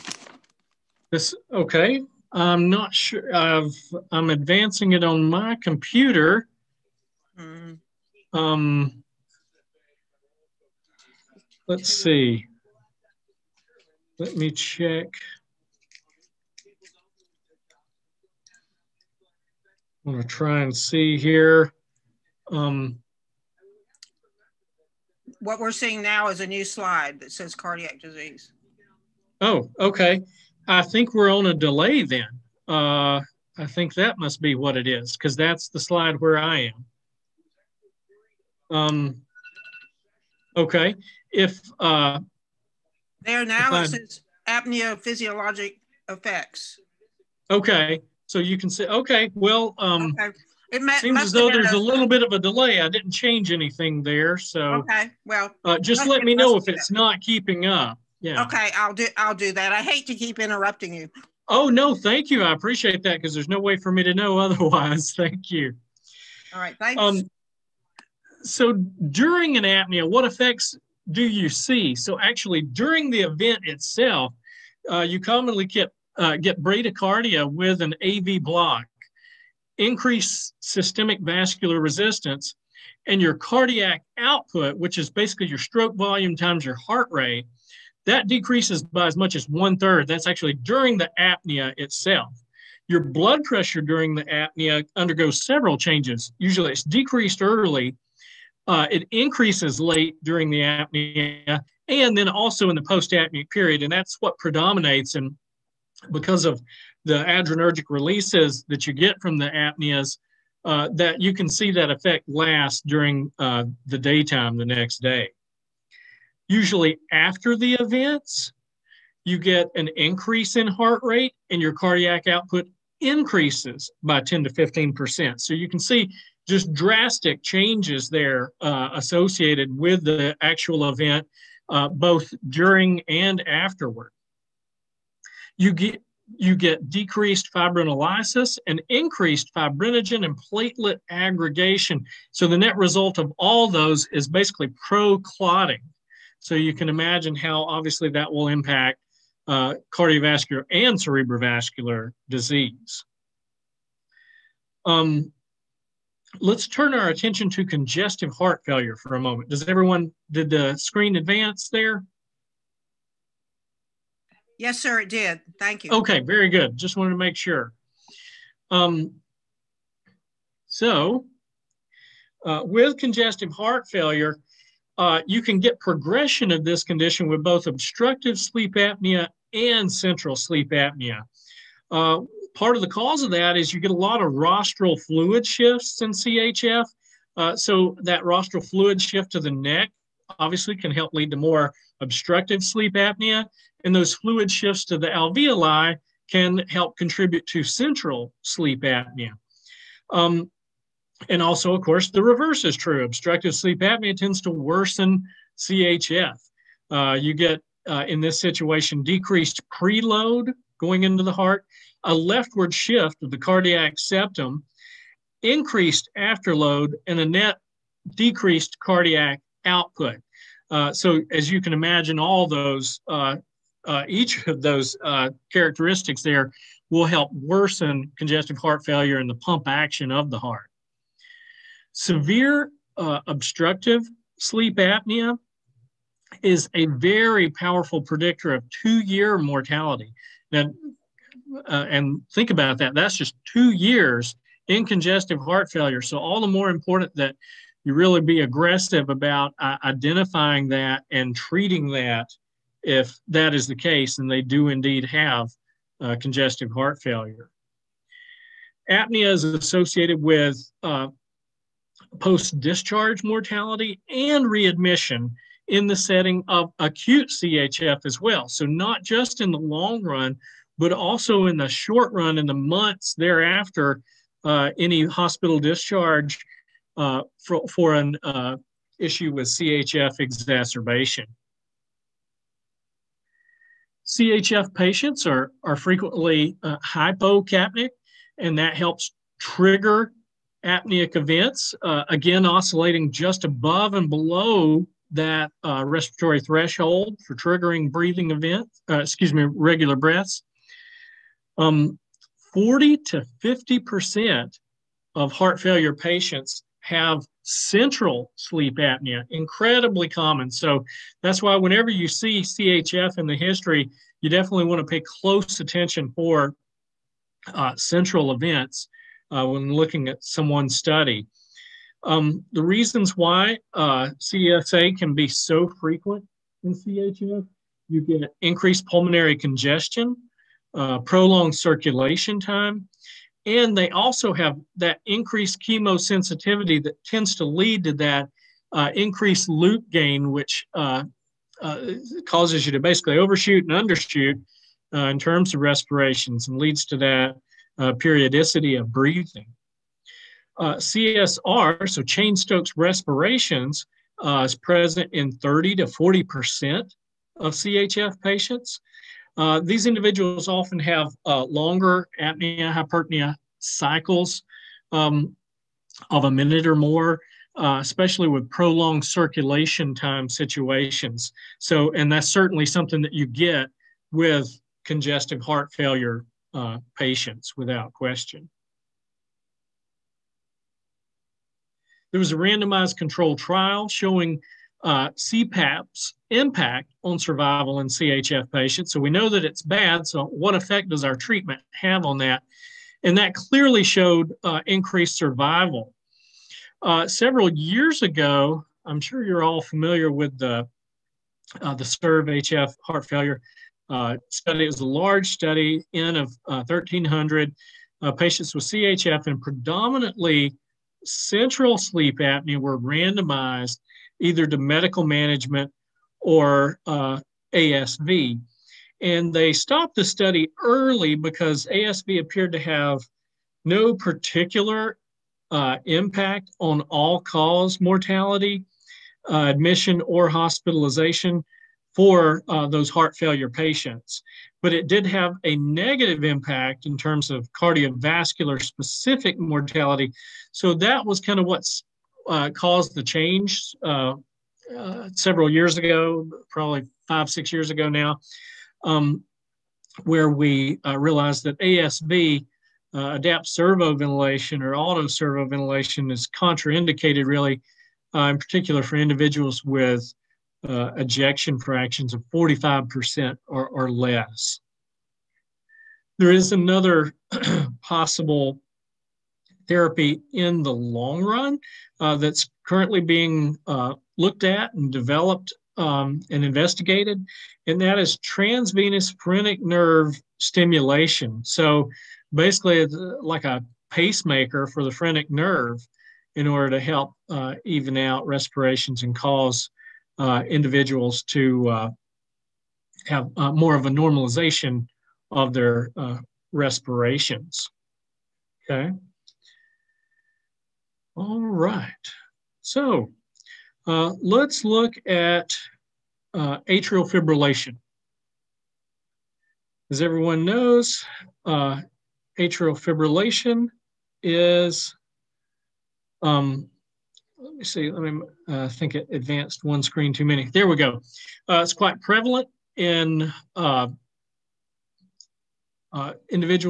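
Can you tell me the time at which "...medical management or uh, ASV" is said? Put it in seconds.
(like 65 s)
414 s.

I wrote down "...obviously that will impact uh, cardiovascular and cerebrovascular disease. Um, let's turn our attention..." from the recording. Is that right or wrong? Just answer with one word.
right.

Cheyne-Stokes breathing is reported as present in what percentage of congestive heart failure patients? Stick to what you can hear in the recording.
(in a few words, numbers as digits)
30 to 40%.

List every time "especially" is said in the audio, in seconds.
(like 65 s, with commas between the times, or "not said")
367 s.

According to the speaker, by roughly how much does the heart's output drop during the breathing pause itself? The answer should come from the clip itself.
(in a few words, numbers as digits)
one third.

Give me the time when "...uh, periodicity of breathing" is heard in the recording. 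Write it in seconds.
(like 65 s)
347 s.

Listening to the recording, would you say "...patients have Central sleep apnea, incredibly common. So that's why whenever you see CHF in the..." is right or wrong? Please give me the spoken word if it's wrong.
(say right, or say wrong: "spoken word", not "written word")
right.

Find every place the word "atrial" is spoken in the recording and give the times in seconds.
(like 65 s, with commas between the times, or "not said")
506 s, 512 s.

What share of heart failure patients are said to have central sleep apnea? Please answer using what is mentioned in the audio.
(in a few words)
40 to 50%.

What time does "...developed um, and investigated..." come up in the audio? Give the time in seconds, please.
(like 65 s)
474 s.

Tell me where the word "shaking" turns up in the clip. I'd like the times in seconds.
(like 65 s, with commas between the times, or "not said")
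not said.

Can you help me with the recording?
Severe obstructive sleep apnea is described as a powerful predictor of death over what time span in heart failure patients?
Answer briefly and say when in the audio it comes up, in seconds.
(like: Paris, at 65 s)
two years, at 238 s.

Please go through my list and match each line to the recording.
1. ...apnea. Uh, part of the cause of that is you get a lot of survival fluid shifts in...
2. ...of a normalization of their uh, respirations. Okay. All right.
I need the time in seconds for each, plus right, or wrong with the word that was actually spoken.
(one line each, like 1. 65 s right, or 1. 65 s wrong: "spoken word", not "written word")
1. 180 s wrong: "rostral", not "survival"
2. 493 s right.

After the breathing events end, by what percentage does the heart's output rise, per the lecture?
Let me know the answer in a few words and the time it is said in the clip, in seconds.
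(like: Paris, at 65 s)
10 to 15%, at 124 s.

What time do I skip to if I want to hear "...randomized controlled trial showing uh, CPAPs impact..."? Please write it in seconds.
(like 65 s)
382 s.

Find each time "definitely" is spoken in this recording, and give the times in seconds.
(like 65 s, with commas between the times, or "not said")
314 s.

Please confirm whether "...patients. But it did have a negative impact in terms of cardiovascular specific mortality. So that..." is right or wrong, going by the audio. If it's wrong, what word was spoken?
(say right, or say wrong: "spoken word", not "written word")
right.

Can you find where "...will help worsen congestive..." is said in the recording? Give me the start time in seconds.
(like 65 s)
226 s.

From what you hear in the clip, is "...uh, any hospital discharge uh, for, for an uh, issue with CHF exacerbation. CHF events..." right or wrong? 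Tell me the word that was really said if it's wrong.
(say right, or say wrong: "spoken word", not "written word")
wrong: "patients", not "events".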